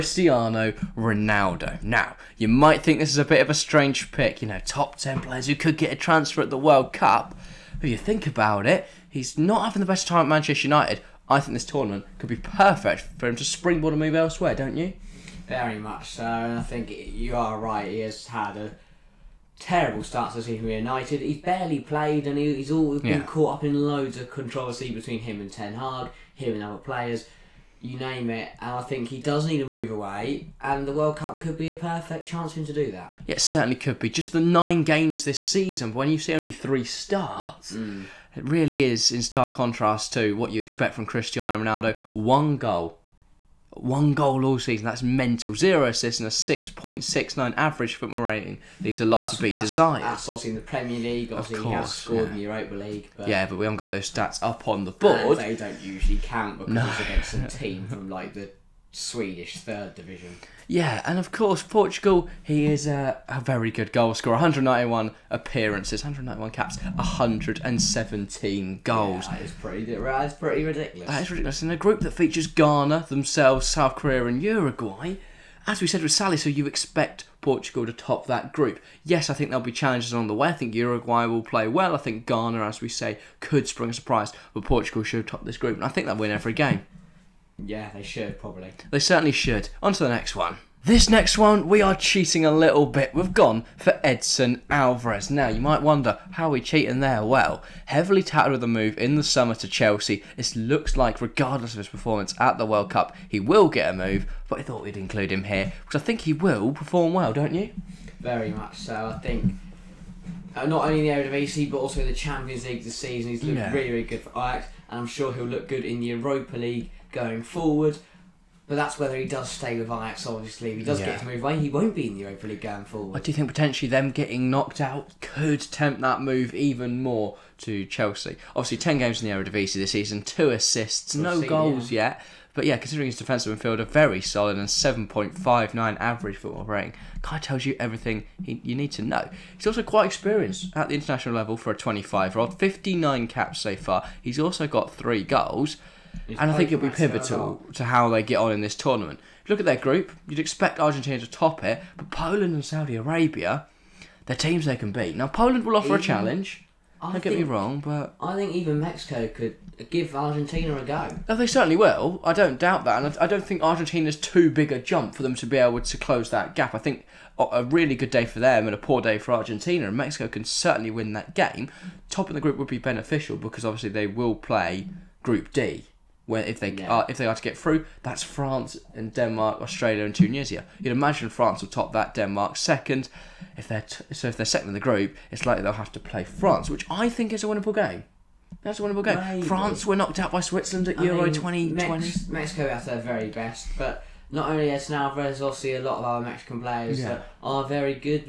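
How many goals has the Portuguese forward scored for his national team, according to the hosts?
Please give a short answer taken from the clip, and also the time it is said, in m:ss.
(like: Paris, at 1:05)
117, at 1:06.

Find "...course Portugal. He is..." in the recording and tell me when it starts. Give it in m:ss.
1:01.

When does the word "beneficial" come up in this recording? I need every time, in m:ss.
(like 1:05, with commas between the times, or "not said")
2:52.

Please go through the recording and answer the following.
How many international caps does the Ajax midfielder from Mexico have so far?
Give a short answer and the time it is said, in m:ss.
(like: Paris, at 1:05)
59, at 2:22.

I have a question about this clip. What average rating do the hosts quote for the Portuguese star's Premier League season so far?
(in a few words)
6.69.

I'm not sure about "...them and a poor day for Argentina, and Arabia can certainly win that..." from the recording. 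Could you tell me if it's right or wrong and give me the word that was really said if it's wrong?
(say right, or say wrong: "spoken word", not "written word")
wrong: "Mexico", not "Arabia".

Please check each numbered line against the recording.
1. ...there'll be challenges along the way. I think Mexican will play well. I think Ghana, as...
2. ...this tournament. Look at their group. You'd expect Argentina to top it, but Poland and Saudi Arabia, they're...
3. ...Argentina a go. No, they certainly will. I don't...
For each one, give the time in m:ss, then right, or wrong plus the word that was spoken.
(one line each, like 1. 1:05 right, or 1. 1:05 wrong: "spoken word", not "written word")
1. 1:19 wrong: "Uruguay", not "Mexican"
2. 2:28 right
3. 2:40 right.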